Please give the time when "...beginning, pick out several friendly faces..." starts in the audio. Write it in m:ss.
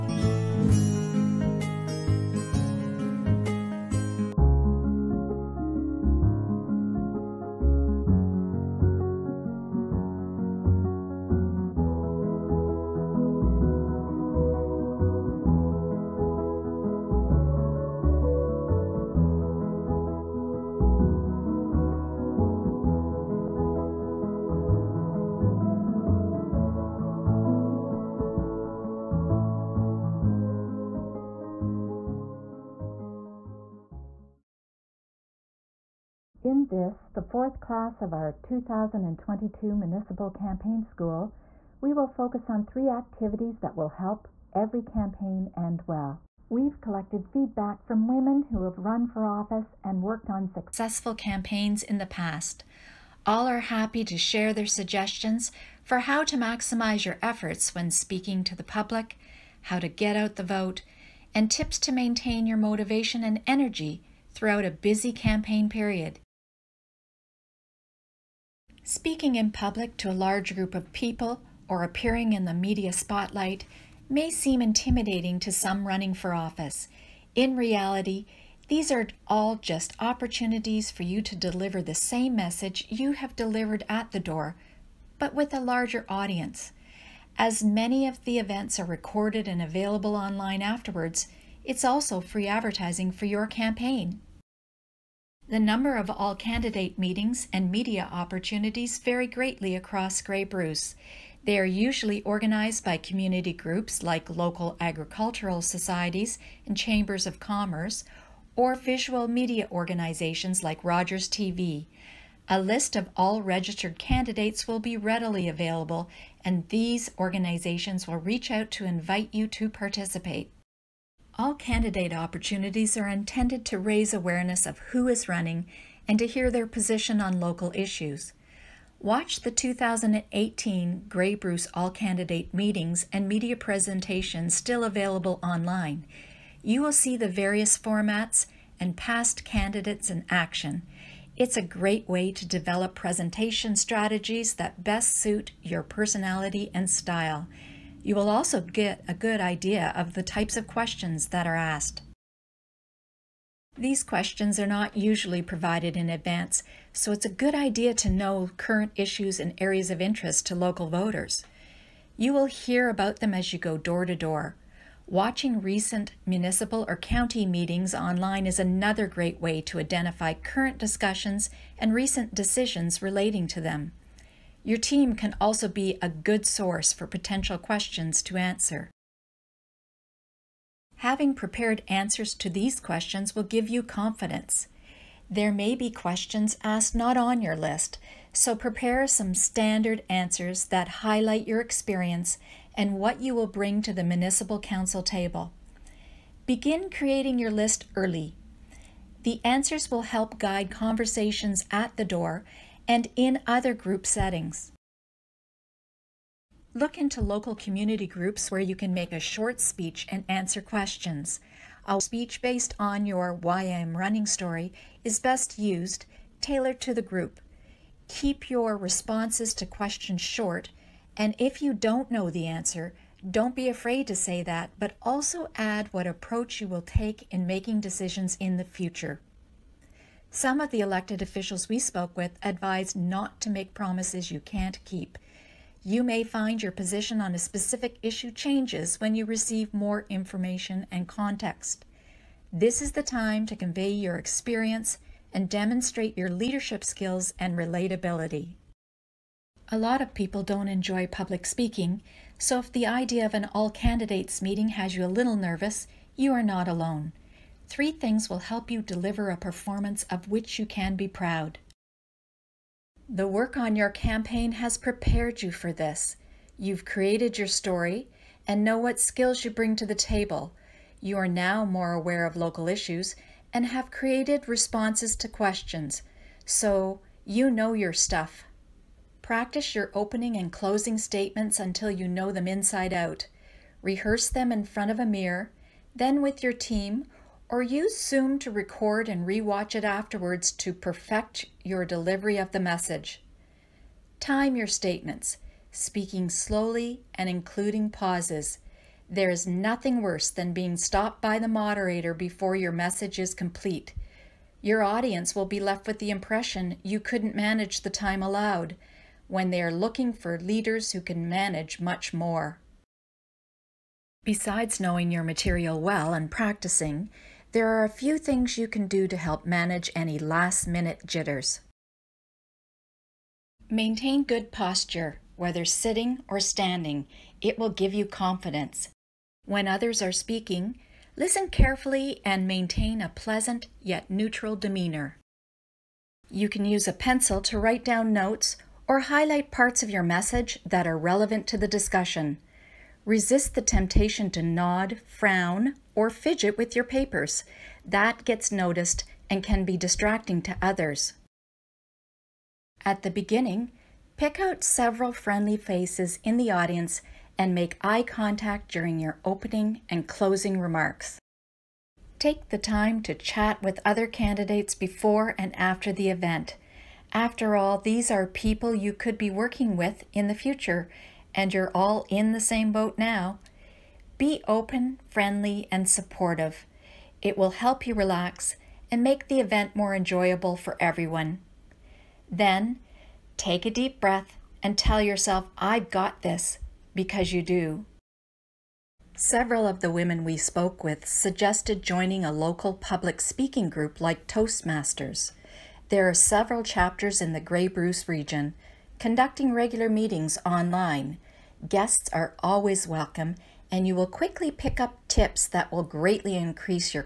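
5:53.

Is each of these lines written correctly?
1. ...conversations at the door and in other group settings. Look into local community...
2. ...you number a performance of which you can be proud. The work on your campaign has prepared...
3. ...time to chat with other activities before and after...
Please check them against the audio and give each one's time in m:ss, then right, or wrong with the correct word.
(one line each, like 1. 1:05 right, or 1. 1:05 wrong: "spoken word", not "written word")
1. 3:20 right
2. 4:18 wrong: "deliver", not "number"
3. 6:02 wrong: "candidates", not "activities".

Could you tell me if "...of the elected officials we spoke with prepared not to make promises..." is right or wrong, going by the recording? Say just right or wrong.
wrong.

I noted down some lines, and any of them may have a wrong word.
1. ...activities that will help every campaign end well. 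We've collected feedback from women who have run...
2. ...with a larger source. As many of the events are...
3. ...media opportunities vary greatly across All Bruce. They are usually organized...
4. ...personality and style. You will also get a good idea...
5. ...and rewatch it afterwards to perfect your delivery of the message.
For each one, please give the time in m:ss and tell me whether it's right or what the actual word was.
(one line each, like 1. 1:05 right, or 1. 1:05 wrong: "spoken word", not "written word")
1. 0:42 right
2. 1:25 wrong: "audience", not "source"
3. 1:37 wrong: "Grey", not "All"
4. 2:25 right
5. 4:49 right.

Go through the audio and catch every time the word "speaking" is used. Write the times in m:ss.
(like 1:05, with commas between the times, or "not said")
0:57, 1:08, 4:11, 4:55, 5:30, 6:33.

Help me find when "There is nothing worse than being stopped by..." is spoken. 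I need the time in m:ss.
4:59.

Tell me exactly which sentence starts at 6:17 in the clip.
It will help you relax and make the event more enjoyable for everyone.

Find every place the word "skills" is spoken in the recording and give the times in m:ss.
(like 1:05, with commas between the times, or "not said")
4:06, 4:28.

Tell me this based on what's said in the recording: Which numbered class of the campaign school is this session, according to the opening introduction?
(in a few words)
fourth.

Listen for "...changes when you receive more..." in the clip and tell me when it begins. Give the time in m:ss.
3:58.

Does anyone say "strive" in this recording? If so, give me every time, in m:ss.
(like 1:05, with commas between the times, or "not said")
not said.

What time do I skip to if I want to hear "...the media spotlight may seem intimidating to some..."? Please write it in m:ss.
1:12.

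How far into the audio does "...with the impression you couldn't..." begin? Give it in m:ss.
5:05.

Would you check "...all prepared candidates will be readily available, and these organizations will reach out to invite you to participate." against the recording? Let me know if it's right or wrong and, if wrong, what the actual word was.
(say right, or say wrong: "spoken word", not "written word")
wrong: "registered", not "prepared".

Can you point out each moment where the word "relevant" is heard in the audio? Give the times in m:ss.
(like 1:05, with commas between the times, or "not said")
5:40.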